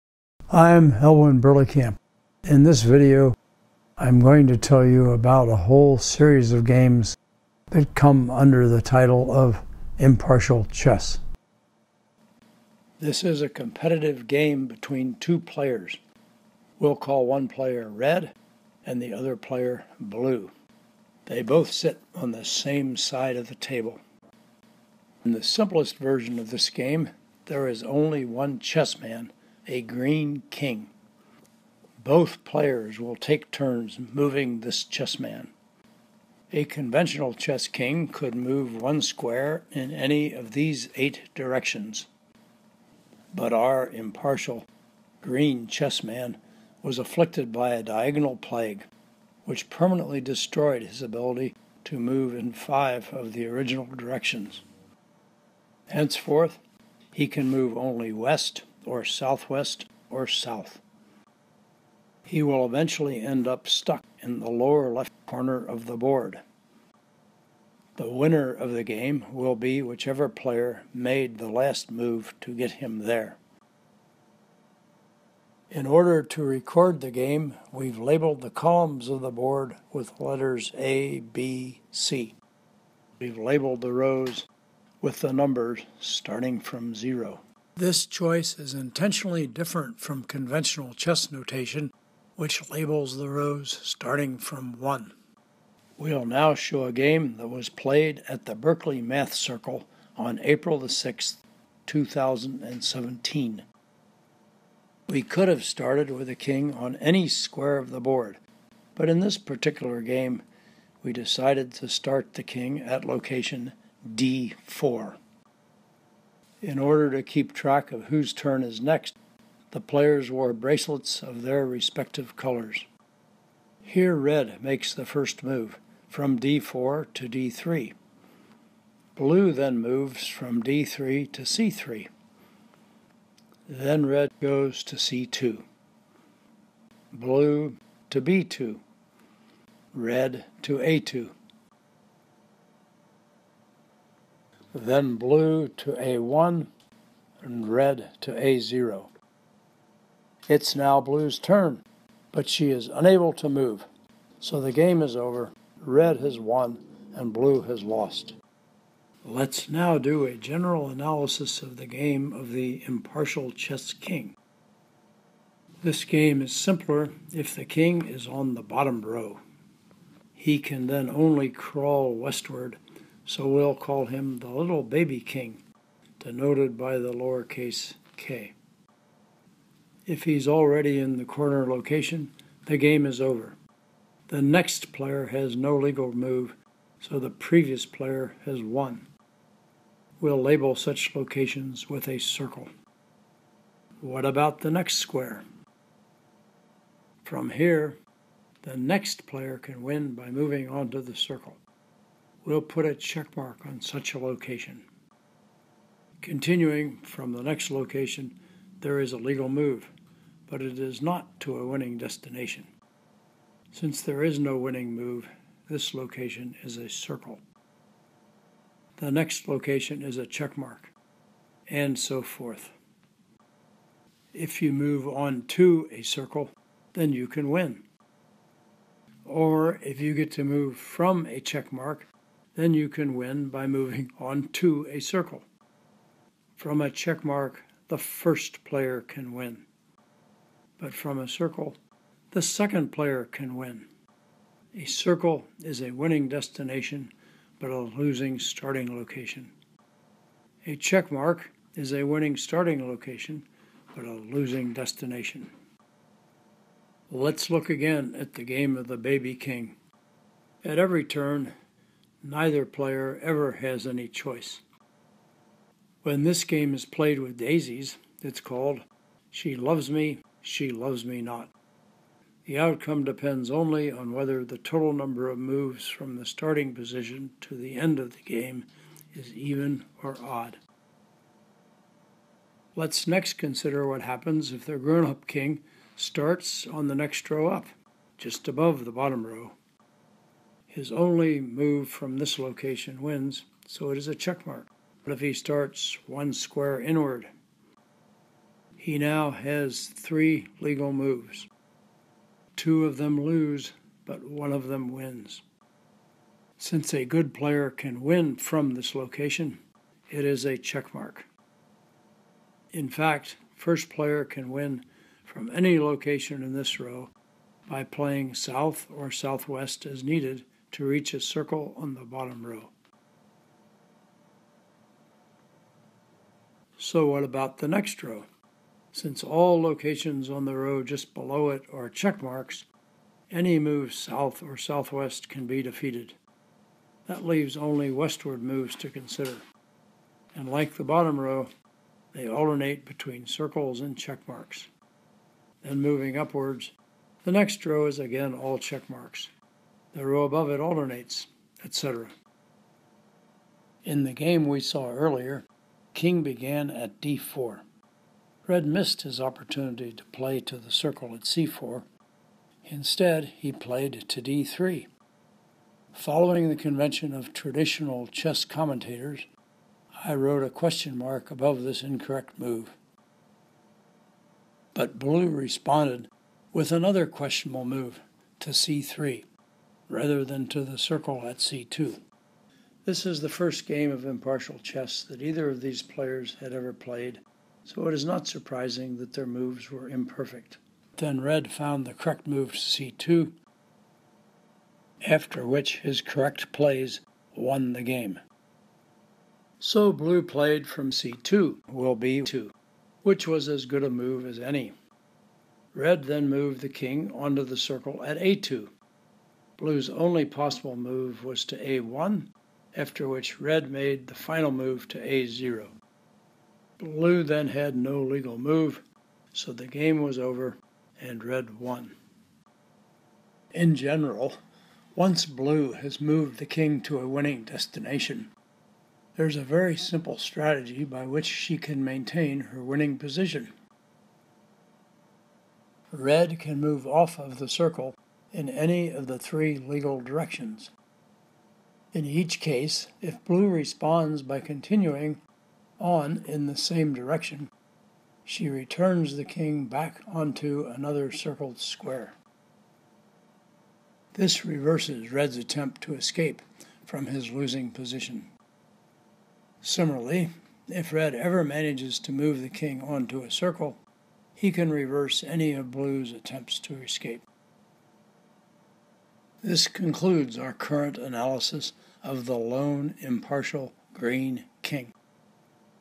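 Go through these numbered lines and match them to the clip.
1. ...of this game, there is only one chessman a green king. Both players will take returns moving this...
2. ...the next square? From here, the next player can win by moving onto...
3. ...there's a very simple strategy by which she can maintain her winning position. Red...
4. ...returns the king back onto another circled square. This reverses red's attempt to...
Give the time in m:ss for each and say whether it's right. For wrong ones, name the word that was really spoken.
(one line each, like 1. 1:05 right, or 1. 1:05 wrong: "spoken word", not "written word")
1. 0:26 wrong: "turns", not "returns"
2. 3:14 right
3. 7:09 right
4. 7:28 right.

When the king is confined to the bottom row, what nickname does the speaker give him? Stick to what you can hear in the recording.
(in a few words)
Little baby king.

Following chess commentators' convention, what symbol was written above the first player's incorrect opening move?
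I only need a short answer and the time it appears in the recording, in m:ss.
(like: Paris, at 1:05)
Question mark, at 6:10.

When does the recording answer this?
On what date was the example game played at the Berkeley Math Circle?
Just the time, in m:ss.
1:40.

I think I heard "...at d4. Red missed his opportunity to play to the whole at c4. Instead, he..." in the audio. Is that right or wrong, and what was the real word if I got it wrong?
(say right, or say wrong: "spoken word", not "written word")
wrong: "circle", not "whole".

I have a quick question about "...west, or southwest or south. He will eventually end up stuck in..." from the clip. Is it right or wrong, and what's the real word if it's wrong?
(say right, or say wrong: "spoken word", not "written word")
right.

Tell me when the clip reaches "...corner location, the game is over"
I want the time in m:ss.
3:01.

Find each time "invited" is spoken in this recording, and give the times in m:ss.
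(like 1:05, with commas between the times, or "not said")
not said.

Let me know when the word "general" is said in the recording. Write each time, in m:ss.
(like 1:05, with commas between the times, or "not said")
2:40, 7:03.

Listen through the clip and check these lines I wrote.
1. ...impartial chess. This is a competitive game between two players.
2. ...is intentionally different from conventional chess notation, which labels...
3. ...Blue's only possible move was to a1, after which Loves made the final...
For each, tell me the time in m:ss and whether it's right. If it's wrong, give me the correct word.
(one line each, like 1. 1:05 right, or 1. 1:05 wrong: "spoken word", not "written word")
1. 0:09 right
2. 1:28 right
3. 6:49 wrong: "Red", not "Loves".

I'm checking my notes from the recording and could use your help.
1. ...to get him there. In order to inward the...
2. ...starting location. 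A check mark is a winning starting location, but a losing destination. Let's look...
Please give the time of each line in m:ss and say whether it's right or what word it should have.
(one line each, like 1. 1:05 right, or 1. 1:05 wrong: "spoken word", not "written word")
1. 1:12 wrong: "record", not "inward"
2. 4:08 right.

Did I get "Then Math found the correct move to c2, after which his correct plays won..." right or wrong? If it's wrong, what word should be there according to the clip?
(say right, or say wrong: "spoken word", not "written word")
wrong: "Red", not "Math".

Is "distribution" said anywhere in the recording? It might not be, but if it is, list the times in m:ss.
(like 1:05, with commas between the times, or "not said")
not said.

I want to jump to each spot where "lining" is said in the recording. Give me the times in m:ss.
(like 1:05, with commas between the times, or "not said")
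not said.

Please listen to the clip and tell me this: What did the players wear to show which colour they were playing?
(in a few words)
Bracelets.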